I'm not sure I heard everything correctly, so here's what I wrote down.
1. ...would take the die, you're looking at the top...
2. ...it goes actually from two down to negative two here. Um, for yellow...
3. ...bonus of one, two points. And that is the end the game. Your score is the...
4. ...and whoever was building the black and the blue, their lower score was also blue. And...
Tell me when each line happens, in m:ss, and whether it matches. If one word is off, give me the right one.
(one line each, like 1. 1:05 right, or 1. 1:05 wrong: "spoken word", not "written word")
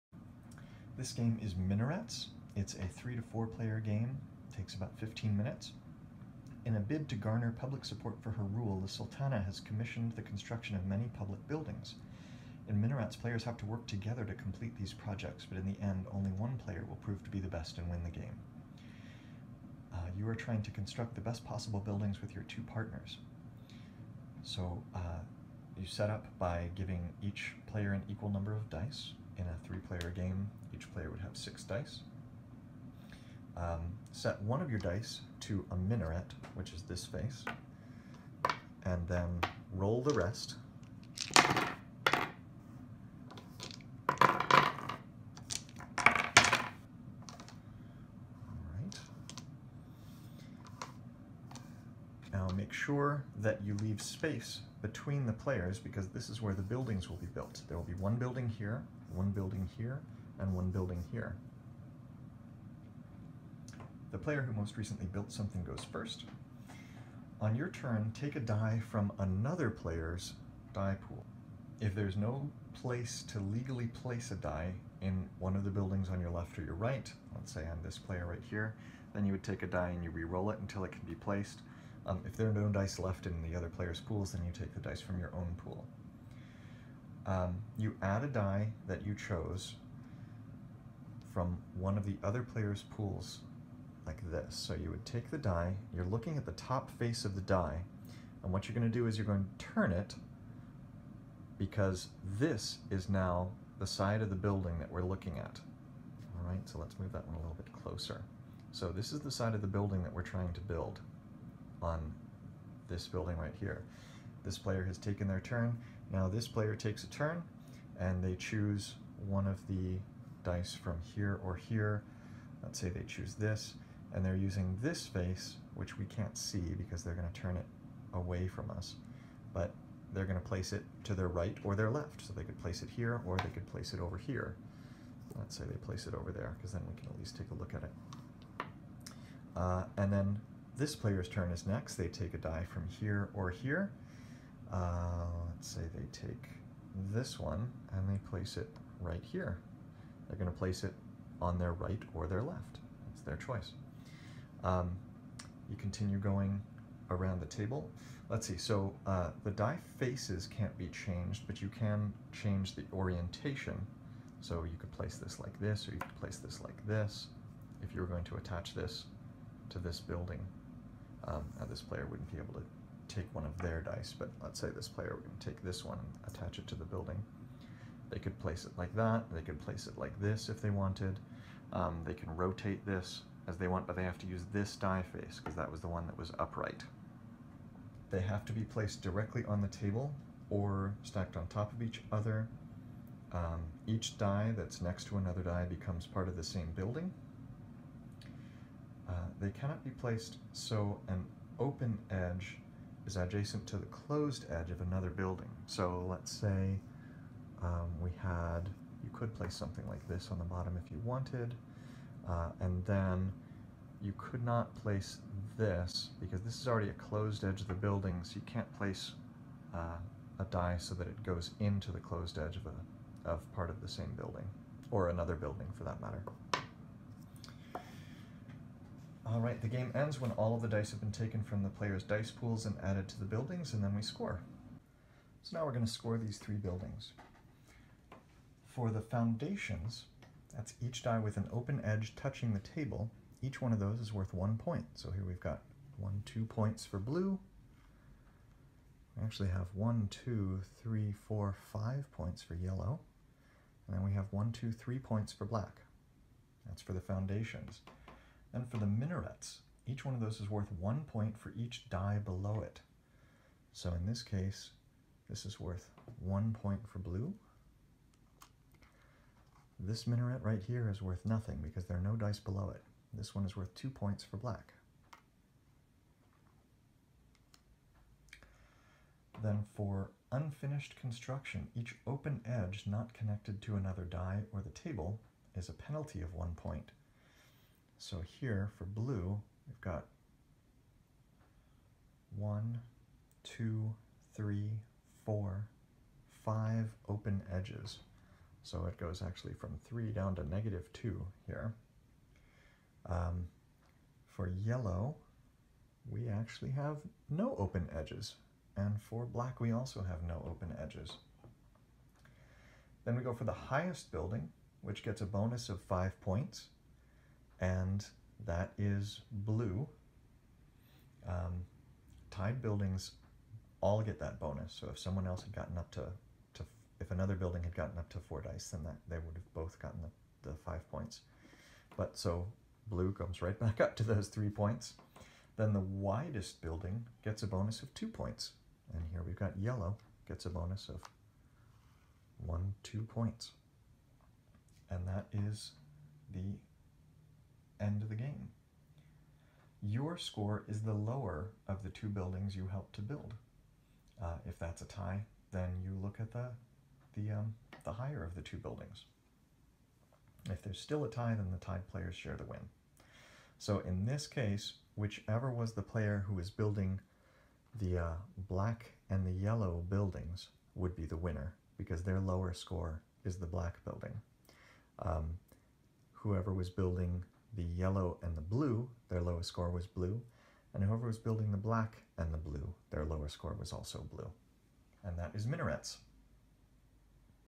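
1. 1:34 right
2. 4:58 wrong: "three", not "two"
3. 5:40 right
4. 6:20 right.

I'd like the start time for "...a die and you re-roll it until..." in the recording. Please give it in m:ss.
1:19.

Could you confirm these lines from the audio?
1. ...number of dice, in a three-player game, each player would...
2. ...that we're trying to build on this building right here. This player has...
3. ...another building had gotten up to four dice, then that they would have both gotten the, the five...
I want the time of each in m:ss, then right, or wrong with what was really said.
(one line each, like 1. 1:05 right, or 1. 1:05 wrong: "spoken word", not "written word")
1. 0:28 right
2. 1:50 right
3. 5:27 right.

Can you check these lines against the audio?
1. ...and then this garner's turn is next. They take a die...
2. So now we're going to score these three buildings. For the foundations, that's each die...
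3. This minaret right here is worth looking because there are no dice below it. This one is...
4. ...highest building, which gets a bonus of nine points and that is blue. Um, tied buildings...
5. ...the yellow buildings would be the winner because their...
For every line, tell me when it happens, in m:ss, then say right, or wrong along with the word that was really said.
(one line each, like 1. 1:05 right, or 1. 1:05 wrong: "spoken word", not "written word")
1. 2:19 wrong: "player", not "garner"
2. 3:55 right
3. 4:29 wrong: "nothing", not "looking"
4. 5:13 wrong: "five", not "nine"
5. 6:09 right.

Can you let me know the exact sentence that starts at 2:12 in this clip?
So they could place it here or they could place it over here.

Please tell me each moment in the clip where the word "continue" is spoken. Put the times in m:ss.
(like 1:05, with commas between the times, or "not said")
2:35.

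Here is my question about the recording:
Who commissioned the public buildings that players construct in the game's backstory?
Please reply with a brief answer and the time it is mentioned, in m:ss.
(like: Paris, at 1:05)
The Sultana, at 0:08.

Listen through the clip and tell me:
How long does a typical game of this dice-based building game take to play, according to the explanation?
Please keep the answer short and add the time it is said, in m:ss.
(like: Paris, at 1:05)
15 minutes, at 0:04.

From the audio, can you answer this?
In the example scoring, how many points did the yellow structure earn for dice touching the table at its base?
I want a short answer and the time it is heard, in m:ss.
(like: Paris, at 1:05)
5, at 4:11.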